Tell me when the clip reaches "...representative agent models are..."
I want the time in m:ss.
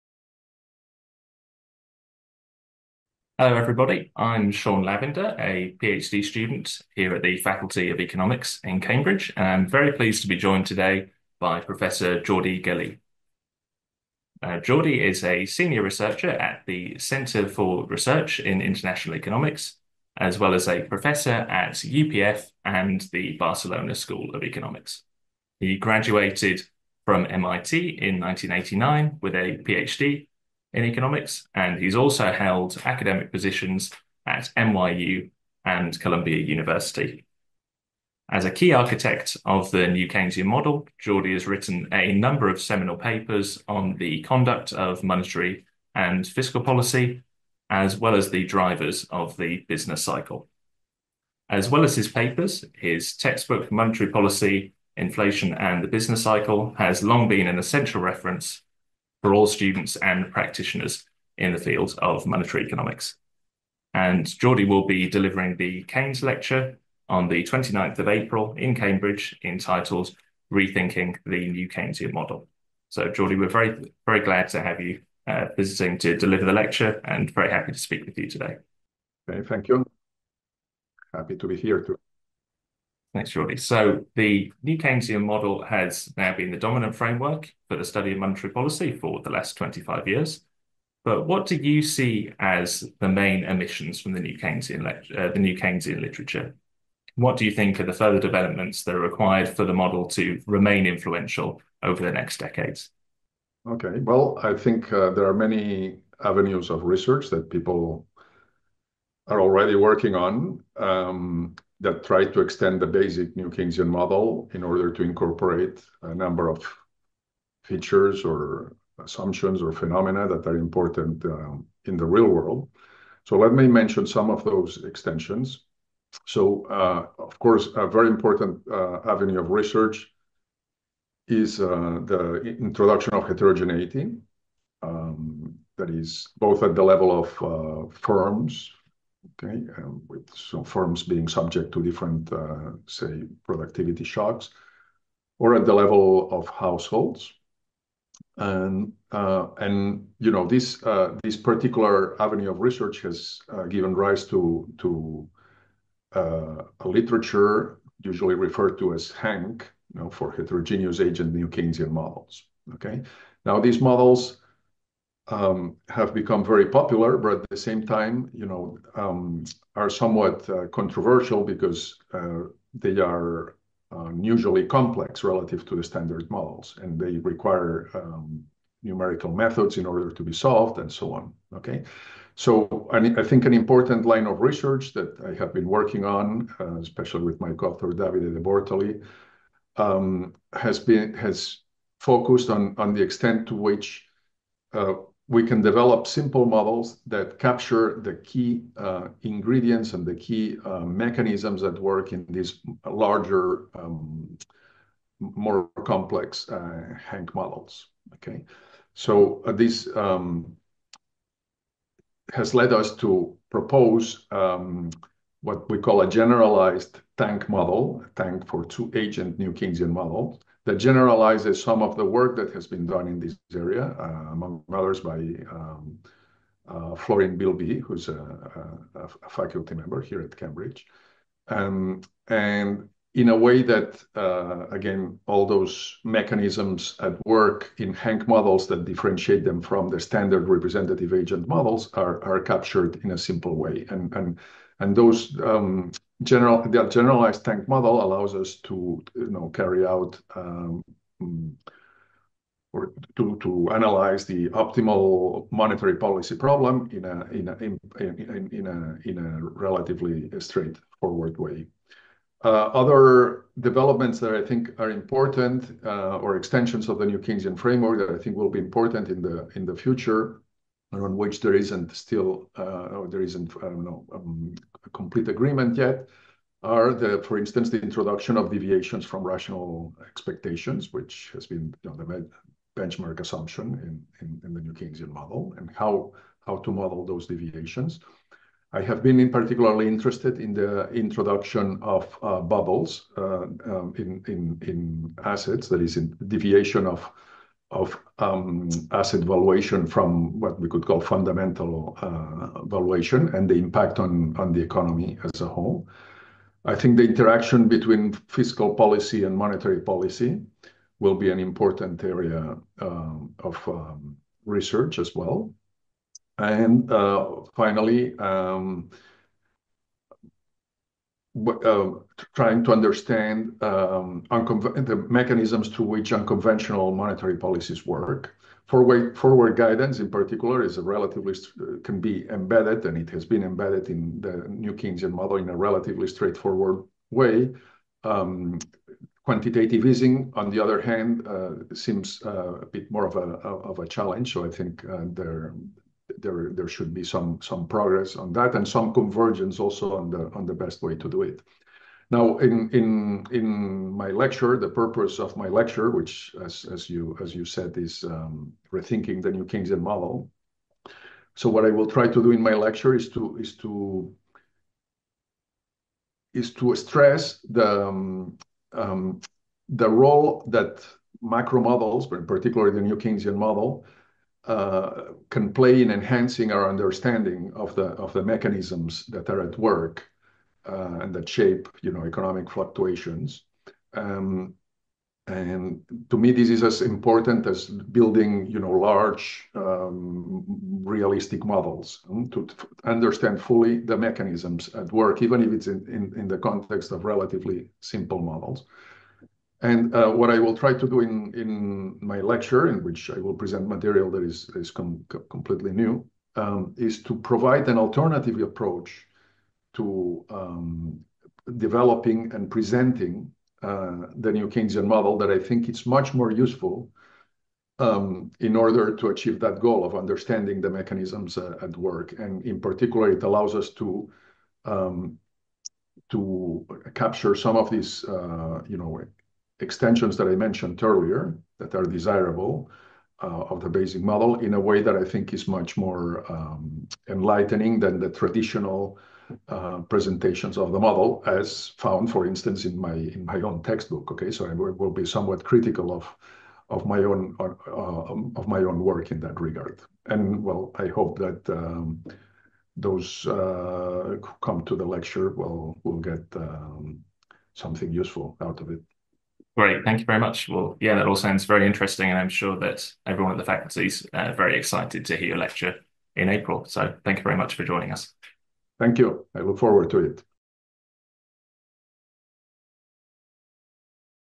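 4:00.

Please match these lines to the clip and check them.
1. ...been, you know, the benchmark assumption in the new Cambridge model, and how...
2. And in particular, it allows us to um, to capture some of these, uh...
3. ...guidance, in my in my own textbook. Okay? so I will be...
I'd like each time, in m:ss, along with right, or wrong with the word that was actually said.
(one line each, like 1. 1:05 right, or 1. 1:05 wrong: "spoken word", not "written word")
1. 4:41 wrong: "Keynesian", not "Cambridge"
2. 7:02 right
3. 7:22 wrong: "instance", not "guidance".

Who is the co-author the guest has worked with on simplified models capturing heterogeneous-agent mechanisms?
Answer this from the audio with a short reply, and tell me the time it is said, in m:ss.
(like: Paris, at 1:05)
Davide Debortoli, at 3:07.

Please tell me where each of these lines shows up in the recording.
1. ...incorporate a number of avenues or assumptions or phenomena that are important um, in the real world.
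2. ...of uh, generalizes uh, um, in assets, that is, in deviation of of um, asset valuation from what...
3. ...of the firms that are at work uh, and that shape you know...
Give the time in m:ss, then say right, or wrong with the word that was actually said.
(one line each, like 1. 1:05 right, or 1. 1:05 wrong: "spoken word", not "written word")
1. 1:55 wrong: "features", not "avenues"
2. 4:51 wrong: "bubbles", not "generalizes"
3. 6:18 wrong: "mechanisms", not "firms".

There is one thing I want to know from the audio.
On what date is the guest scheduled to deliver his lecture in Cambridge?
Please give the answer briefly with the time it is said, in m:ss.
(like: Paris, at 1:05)
29th of April, at 1:07.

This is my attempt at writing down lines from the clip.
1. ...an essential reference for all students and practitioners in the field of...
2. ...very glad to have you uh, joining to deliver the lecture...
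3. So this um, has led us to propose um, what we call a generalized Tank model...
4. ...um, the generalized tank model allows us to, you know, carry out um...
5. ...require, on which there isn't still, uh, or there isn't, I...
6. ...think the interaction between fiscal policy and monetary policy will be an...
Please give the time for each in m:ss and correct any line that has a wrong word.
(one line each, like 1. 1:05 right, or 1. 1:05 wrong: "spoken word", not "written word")
1. 0:57 right
2. 1:14 wrong: "visiting", not "joining"
3. 3:28 right
4. 4:05 right
5. 4:29 wrong: "future", not "require"
6. 5:06 right.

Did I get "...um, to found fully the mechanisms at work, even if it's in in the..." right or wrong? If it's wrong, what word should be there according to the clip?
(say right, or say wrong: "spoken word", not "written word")
wrong: "understand", not "found".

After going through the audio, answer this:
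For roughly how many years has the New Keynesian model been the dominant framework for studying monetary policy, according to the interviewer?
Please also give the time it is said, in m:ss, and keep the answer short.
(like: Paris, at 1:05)
25 years, at 1:29.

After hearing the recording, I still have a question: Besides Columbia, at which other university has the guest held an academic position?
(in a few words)
NYU.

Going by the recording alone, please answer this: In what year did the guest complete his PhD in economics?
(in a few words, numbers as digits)
1989.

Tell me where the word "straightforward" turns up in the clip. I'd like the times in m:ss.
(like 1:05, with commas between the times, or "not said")
4:20, 5:36.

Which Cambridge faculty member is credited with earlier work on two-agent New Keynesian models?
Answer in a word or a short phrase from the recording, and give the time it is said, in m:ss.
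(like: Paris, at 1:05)
Florian Bilbiie, at 3:46.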